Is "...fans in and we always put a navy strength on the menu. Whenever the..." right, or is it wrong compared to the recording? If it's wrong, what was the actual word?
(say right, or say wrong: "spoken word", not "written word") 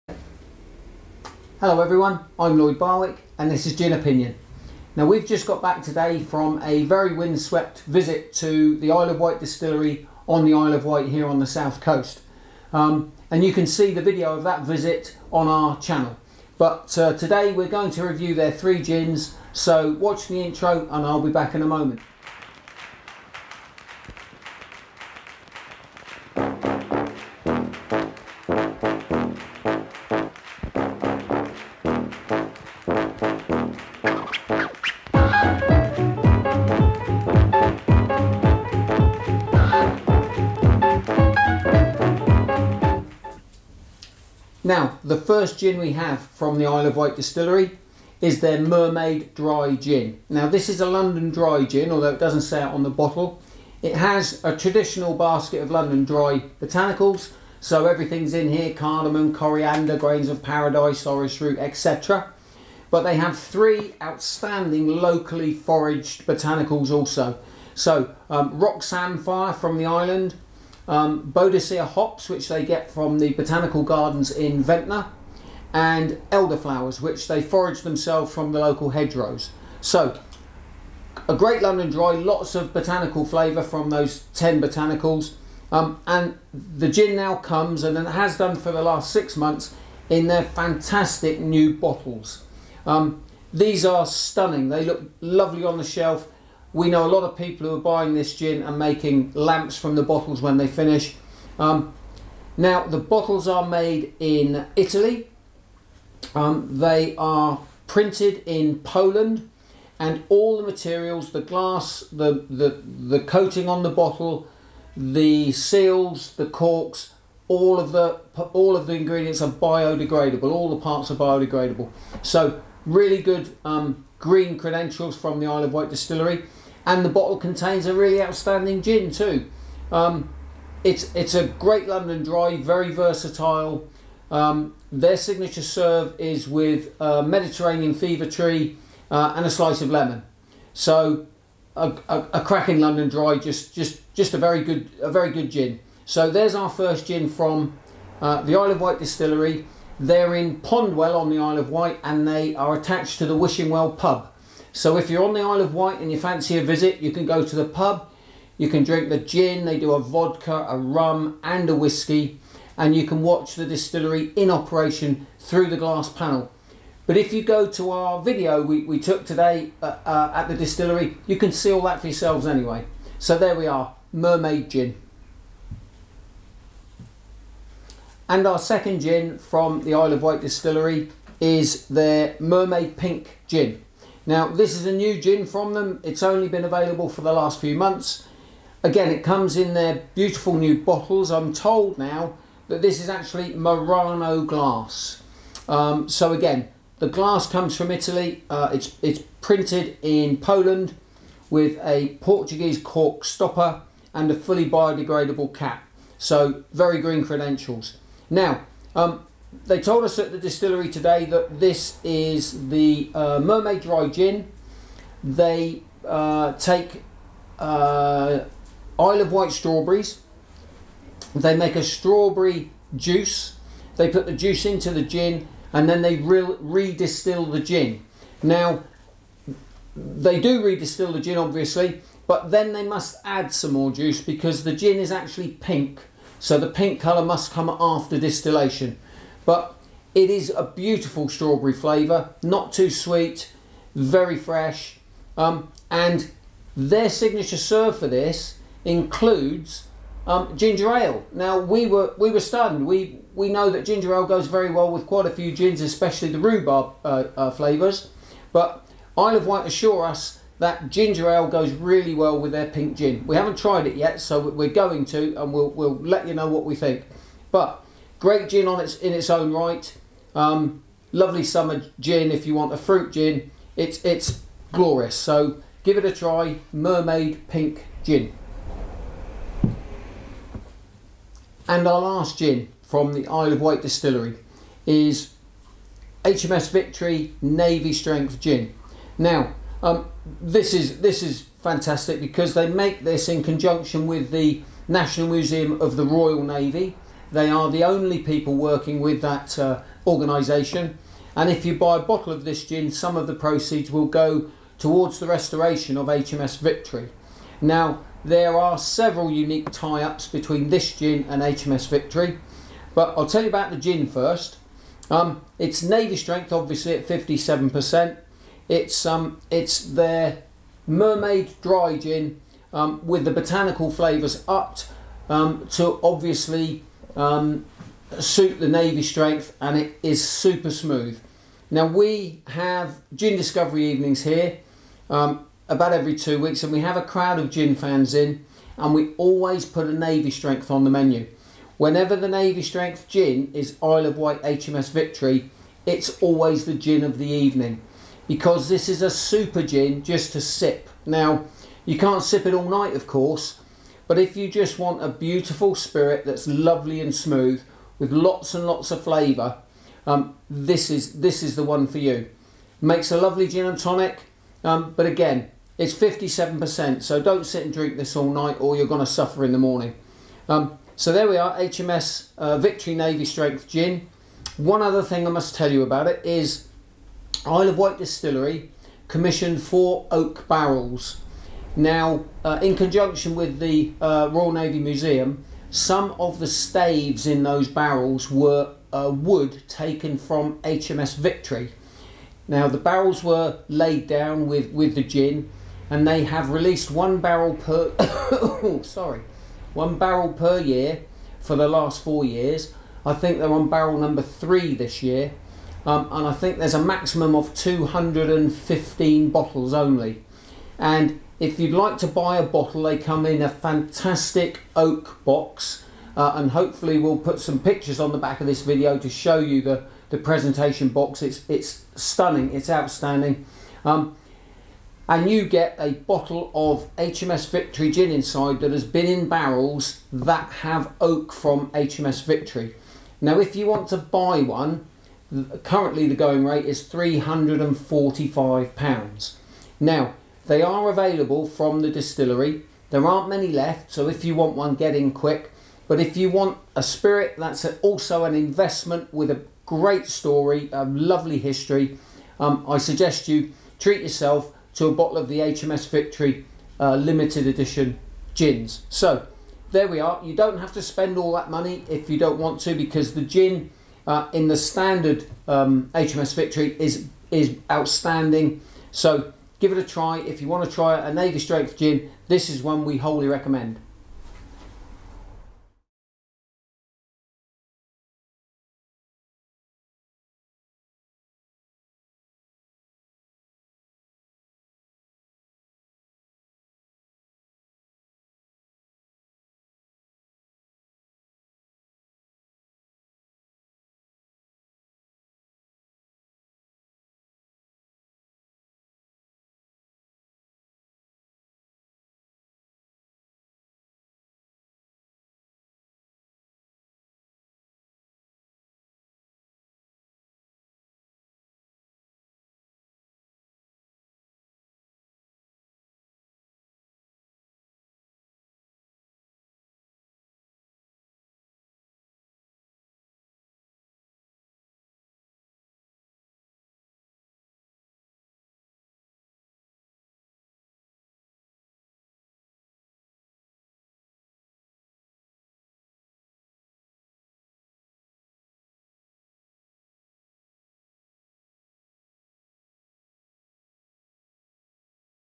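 right.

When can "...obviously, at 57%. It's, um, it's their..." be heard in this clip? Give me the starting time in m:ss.
5:16.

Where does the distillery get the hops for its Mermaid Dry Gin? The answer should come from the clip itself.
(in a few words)
Botanical gardens in Ventnor.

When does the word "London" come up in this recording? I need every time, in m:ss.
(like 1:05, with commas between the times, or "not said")
0:50, 0:55, 1:21, 2:11, 2:22.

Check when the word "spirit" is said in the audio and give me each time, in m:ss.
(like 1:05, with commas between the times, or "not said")
5:55, 7:26.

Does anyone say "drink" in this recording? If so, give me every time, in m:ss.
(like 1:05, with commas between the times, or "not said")
2:38, 6:07.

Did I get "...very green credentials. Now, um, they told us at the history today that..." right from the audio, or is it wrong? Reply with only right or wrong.
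wrong.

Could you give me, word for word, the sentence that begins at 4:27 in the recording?
But Great gin on its in its own right.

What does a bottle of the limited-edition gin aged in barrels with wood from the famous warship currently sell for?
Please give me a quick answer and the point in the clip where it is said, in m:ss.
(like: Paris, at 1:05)
£345, at 7:16.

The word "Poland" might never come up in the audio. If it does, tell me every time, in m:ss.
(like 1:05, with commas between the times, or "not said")
1:48, 3:20.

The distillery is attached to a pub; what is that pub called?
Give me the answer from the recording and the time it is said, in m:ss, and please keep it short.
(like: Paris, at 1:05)
Wishing Well, at 2:33.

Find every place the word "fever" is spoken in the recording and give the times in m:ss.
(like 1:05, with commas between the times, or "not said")
2:17.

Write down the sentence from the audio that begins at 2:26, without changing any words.
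So there's our first gin from uh, the Isle of Wight distillery.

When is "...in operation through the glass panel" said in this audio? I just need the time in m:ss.
2:44.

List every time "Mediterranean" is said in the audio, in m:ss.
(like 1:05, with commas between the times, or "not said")
2:17.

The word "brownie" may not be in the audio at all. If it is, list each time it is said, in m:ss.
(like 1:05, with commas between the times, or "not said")
not said.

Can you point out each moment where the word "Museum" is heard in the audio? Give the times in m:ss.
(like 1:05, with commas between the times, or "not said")
4:55, 6:24.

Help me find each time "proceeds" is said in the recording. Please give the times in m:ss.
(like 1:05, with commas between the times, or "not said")
5:03.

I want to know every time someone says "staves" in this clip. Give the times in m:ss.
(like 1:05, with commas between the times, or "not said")
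6:26.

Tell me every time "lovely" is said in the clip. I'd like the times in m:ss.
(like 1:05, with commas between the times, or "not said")
1:35, 4:31, 5:56, 6:03, 7:30.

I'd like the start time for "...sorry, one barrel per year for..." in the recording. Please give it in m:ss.
6:38.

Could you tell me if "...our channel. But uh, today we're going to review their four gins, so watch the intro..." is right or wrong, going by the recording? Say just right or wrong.
wrong.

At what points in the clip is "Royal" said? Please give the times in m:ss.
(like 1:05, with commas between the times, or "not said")
4:56, 6:24.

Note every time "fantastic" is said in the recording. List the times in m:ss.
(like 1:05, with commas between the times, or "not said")
1:30, 4:51, 6:53.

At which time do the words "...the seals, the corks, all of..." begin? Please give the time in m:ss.
1:54.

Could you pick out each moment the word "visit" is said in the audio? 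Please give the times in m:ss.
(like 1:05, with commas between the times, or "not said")
0:07, 0:14, 2:36.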